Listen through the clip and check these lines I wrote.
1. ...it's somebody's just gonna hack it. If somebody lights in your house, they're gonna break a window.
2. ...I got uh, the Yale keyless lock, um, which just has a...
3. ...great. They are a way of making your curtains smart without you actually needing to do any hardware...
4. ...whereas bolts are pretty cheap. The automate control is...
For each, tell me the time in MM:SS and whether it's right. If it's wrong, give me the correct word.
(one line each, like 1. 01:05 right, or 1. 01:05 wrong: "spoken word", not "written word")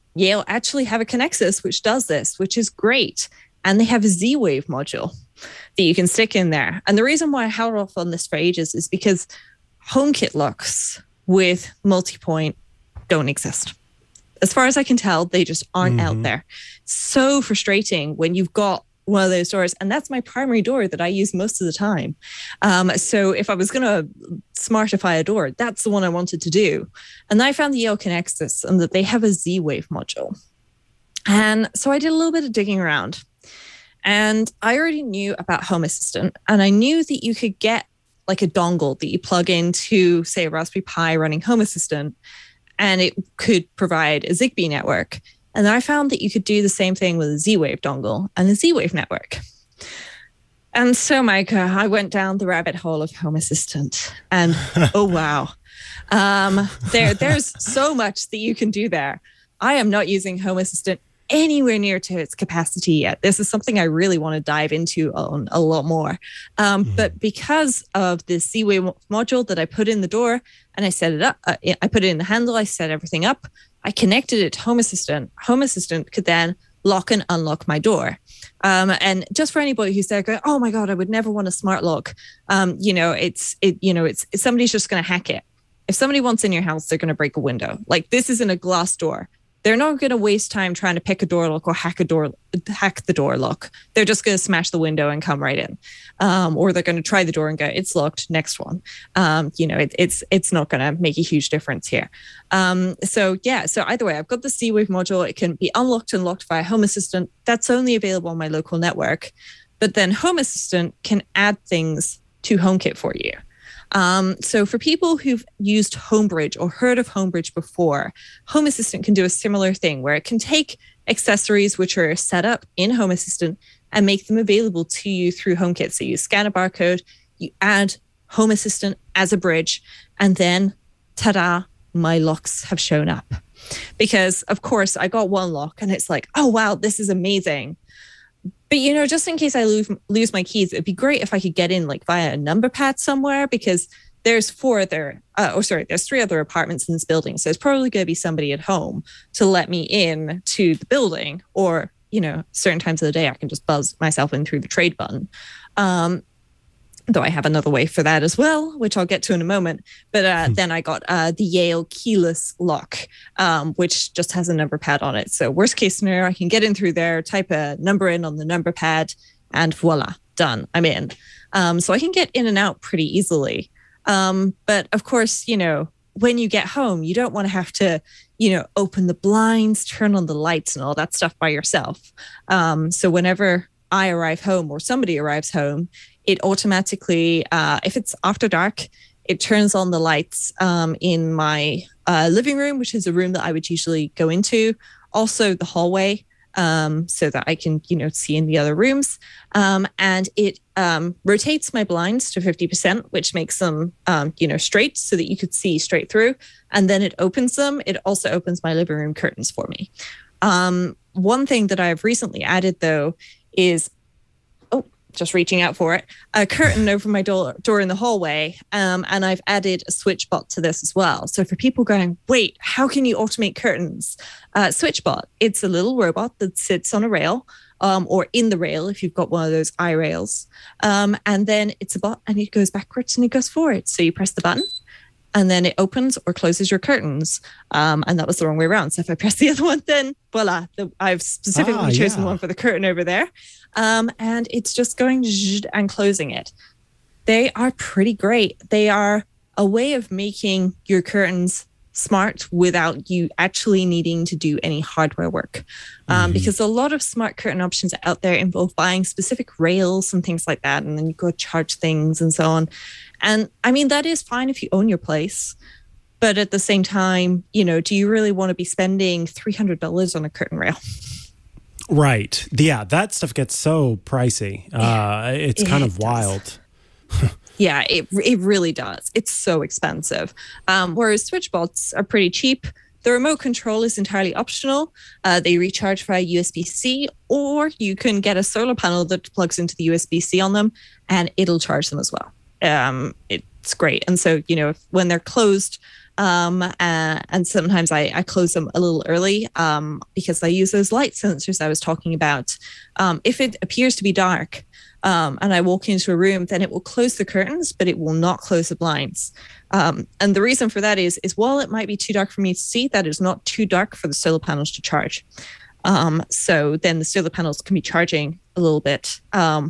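1. 01:24 wrong: "wants", not "lights"
2. 02:40 right
3. 04:08 right
4. 04:40 wrong: "remote", not "automate".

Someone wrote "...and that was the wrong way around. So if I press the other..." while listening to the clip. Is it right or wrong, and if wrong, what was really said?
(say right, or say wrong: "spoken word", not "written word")
right.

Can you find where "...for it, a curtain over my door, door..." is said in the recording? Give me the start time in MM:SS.
03:35.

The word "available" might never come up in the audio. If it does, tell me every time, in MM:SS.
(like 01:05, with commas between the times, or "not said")
01:47, 02:04.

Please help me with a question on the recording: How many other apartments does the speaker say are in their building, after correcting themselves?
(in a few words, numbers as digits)
3.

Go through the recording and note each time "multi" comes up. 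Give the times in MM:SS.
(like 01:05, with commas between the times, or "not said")
00:11.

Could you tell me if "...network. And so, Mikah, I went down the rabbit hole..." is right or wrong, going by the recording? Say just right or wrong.
right.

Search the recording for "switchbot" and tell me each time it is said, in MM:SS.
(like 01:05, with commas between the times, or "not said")
03:39, 03:44.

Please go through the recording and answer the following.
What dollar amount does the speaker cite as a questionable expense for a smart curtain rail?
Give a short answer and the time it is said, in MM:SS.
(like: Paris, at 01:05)
$300, at 04:29.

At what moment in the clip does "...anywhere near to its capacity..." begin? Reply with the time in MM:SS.
01:01.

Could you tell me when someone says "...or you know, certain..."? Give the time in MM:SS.
02:31.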